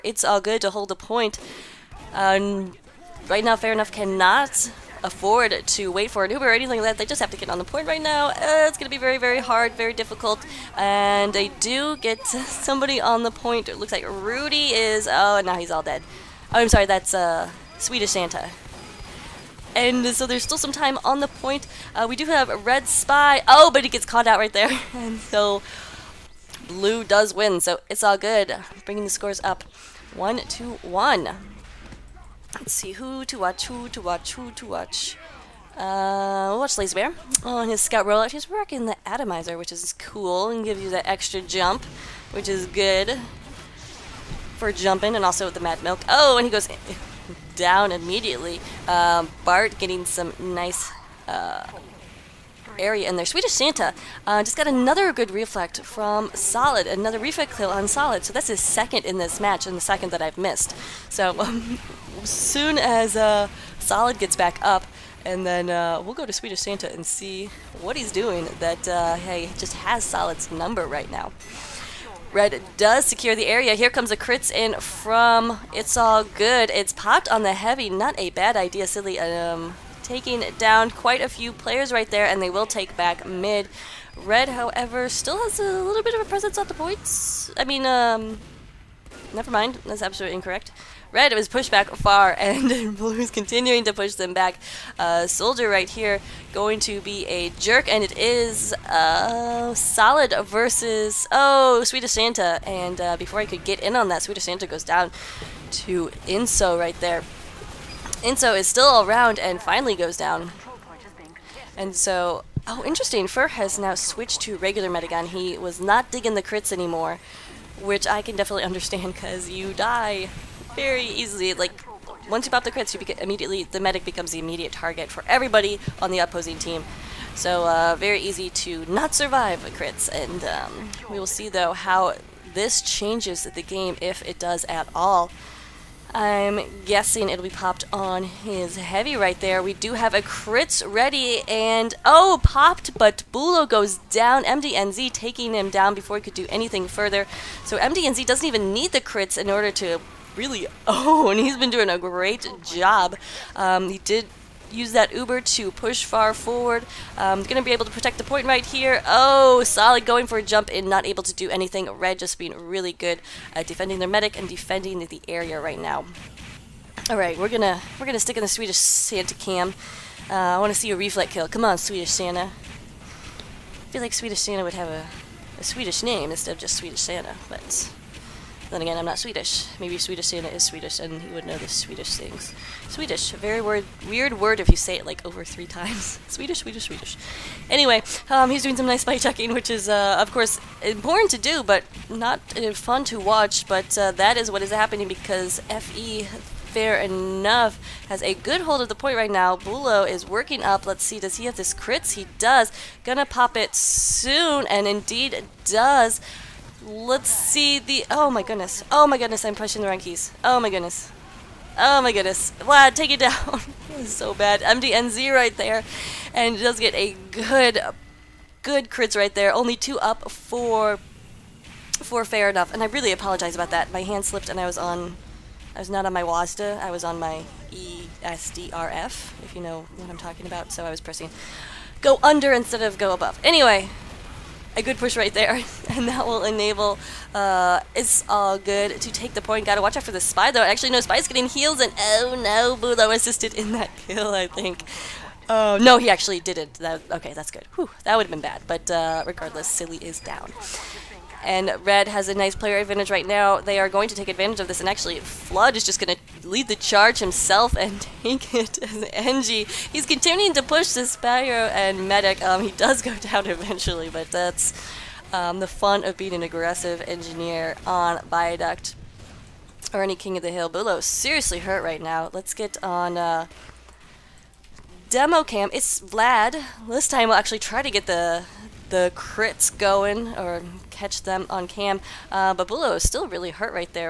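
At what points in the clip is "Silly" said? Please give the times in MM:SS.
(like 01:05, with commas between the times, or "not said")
01:18, 04:09.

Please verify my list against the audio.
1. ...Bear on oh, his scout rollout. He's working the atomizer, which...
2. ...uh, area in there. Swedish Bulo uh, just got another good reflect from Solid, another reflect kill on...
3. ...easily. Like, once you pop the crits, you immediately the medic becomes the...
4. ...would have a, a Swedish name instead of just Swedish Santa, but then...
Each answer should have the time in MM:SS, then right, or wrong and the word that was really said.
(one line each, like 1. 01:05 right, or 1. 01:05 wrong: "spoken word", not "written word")
1. 00:36 right
2. 00:51 wrong: "Santa", not "Bulo"
3. 02:01 right
4. 02:54 right.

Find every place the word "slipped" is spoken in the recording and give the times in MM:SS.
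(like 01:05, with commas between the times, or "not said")
03:44.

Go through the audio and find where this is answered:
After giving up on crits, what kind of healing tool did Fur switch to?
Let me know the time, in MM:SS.
01:54.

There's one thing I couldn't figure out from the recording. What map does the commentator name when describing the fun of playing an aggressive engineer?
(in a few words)
Viaduct.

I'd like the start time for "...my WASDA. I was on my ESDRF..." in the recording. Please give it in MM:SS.
03:46.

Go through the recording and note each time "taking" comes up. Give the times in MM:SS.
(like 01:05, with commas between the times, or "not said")
01:20, 02:25.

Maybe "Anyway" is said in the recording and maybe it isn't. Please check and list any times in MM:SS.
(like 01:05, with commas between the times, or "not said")
03:07, 03:53.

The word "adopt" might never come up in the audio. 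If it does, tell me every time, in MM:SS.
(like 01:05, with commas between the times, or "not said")
not said.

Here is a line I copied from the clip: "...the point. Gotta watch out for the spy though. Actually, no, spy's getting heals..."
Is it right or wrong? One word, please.
right.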